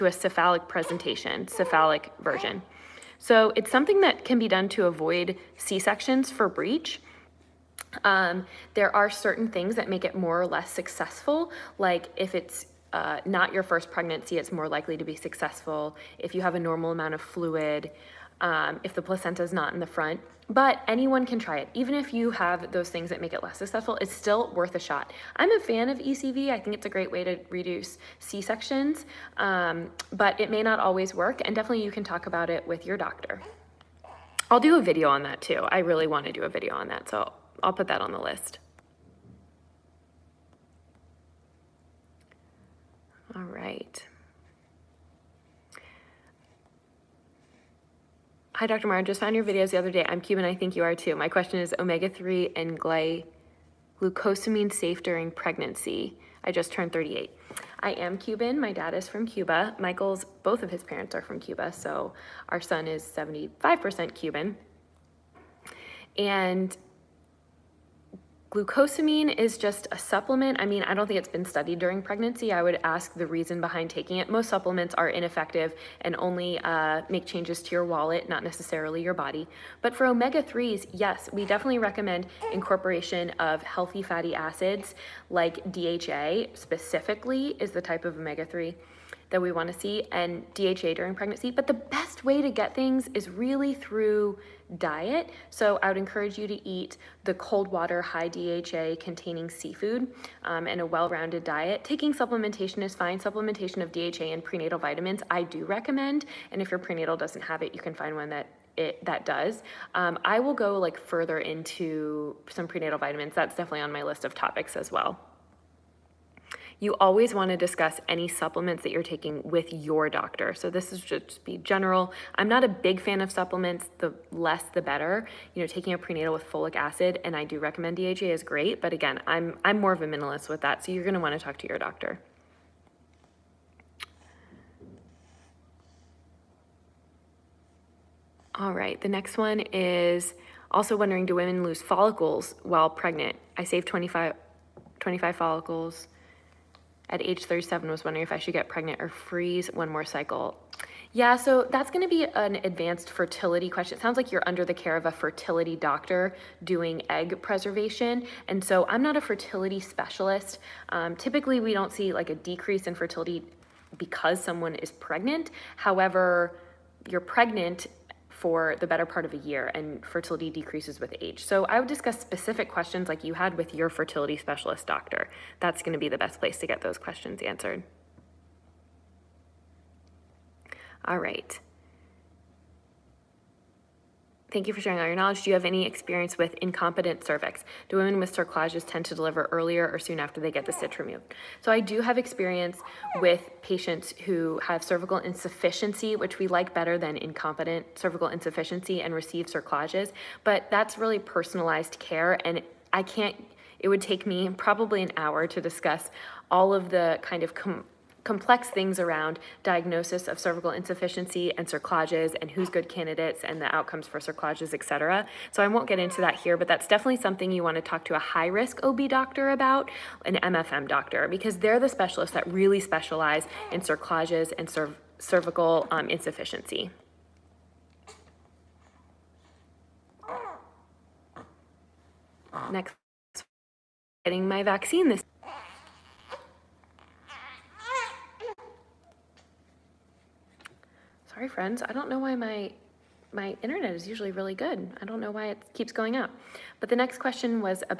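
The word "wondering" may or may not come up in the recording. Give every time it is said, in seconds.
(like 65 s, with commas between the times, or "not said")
140 s, 148 s.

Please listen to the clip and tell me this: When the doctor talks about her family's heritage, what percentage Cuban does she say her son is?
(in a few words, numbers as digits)
75%.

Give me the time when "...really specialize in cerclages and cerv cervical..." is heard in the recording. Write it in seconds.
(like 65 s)
222 s.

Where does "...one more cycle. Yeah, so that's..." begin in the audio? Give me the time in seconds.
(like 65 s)
149 s.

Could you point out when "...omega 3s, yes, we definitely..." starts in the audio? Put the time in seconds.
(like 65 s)
80 s.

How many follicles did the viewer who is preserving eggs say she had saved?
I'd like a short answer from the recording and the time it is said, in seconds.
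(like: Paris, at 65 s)
25, at 144 s.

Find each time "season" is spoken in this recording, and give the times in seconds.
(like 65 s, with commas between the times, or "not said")
not said.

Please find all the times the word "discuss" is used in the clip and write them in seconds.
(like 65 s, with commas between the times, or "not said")
117 s, 171 s, 205 s.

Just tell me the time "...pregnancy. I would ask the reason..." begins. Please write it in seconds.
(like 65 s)
72 s.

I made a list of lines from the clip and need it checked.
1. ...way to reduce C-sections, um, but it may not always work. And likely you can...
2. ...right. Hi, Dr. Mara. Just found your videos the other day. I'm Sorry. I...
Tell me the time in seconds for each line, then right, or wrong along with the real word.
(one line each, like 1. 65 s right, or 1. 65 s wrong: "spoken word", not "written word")
1. 27 s wrong: "definitely", not "likely"
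2. 43 s wrong: "Cuban", not "Sorry".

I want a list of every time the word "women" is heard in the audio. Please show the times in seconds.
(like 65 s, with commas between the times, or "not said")
141 s, 187 s.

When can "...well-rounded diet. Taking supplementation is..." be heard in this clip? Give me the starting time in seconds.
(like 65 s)
100 s.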